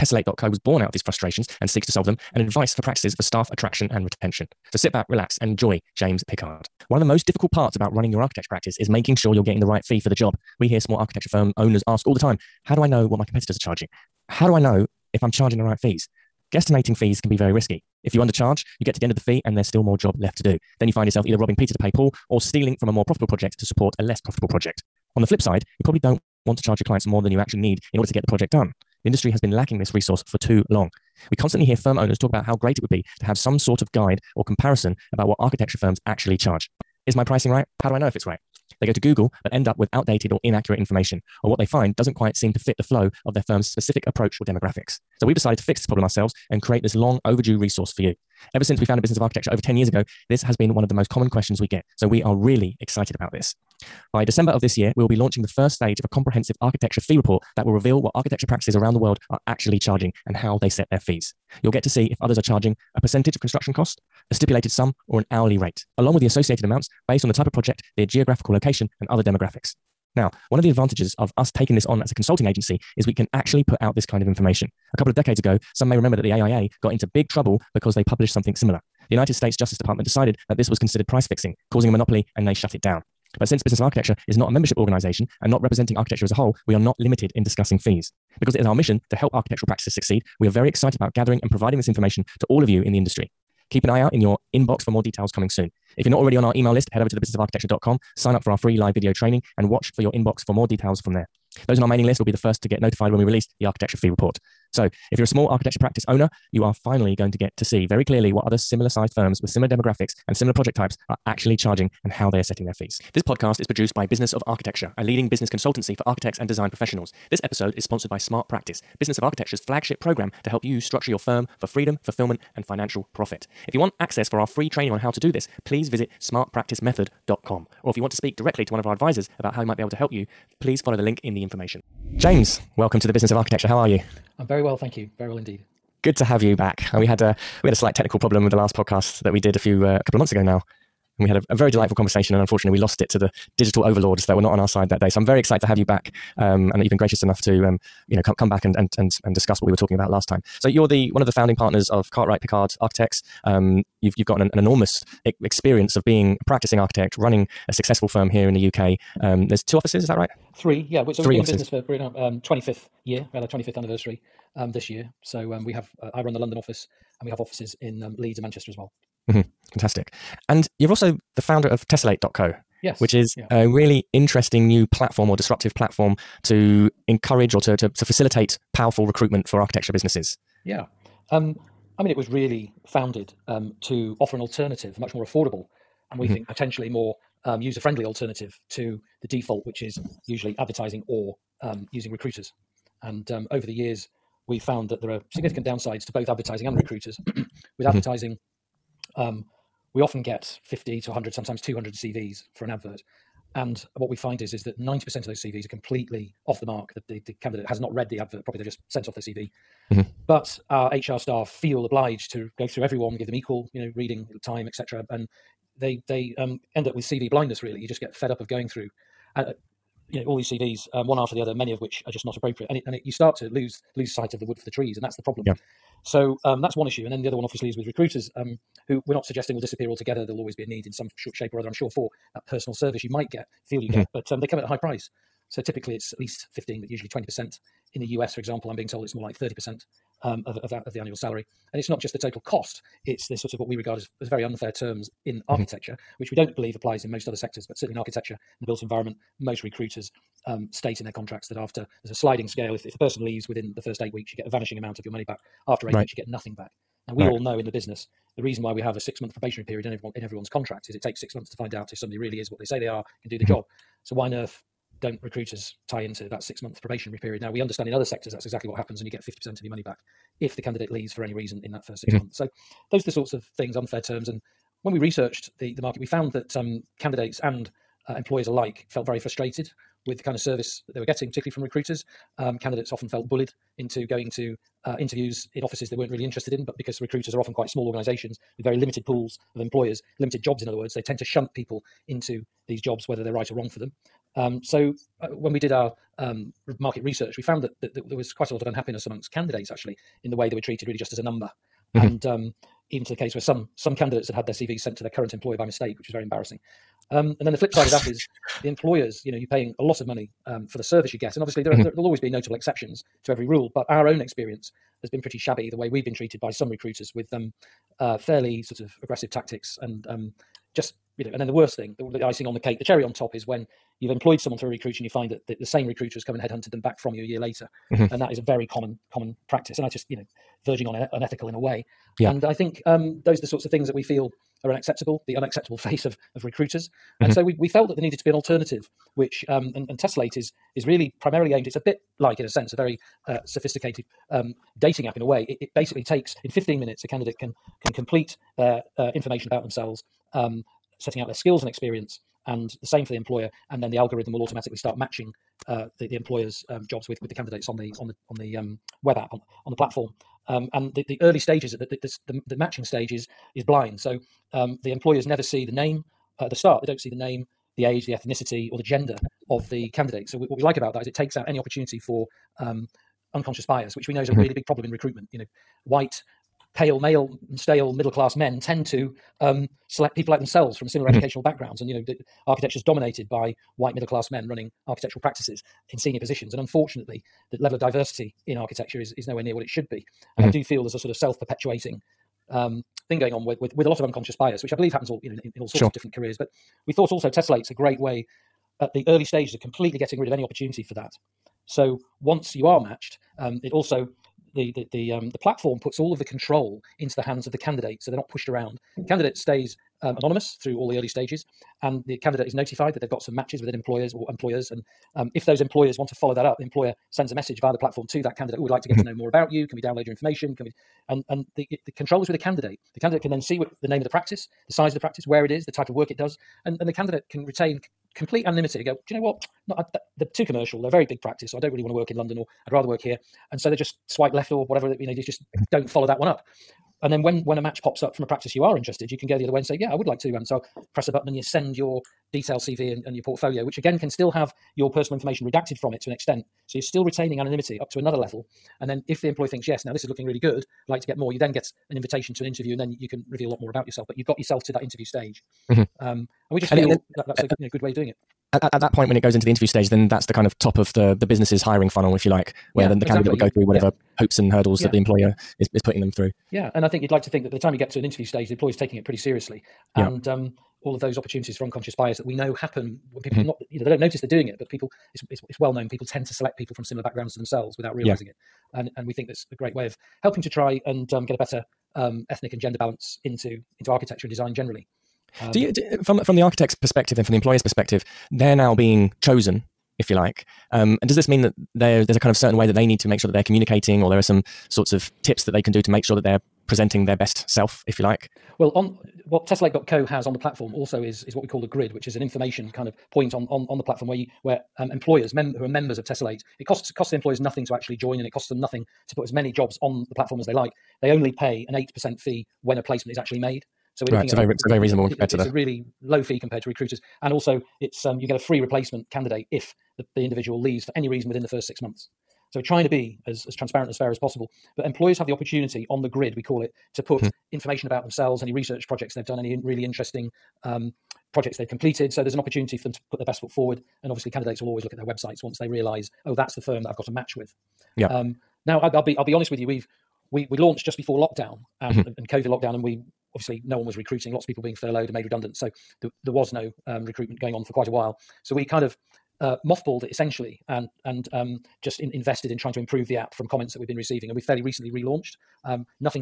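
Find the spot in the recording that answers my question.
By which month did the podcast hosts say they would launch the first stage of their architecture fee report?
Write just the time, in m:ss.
0:54.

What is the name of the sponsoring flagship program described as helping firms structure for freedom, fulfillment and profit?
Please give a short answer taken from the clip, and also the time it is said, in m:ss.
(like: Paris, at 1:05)
Smart Practice, at 1:58.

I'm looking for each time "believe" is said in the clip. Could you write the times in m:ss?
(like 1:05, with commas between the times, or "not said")
4:06, 6:34.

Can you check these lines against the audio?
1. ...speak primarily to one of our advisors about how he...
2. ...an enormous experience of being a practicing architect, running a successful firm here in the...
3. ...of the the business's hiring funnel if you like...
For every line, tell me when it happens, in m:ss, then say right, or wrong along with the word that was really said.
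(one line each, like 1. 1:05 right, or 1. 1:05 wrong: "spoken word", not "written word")
1. 2:08 wrong: "directly", not "primarily"
2. 2:34 right
3. 7:40 right.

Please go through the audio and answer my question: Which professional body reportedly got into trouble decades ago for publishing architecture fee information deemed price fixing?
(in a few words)
AIA.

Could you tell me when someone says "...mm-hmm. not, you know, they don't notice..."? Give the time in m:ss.
7:53.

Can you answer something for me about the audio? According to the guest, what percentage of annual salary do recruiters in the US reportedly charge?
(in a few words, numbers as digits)
30%.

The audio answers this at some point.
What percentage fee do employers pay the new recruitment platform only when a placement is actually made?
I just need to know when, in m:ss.
8:31.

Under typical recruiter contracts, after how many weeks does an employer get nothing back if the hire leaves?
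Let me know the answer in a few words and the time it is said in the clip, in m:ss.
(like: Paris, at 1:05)
8 weeks, at 4:14.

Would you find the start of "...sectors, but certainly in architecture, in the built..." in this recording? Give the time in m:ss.
4:07.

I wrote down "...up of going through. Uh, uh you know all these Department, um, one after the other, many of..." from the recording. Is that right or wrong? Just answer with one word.
wrong.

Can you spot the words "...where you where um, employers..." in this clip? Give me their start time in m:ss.
8:24.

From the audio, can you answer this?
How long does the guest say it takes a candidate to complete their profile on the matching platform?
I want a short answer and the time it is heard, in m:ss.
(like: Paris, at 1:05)
15 minutes, at 5:46.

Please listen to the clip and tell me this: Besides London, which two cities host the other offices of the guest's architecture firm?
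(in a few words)
Leeds and Manchester.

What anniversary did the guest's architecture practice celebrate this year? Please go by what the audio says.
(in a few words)
25th.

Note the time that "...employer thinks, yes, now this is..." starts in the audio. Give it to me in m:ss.
7:29.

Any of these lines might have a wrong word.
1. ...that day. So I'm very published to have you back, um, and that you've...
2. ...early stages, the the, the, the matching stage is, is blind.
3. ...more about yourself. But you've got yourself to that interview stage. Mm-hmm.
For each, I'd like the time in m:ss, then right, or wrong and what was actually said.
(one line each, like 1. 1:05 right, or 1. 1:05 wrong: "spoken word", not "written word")
1. 2:24 wrong: "excited", not "published"
2. 6:01 right
3. 7:33 right.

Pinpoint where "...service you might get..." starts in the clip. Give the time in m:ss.
3:52.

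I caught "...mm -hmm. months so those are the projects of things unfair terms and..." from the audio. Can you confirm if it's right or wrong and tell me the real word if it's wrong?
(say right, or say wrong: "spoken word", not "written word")
wrong: "sorts", not "projects".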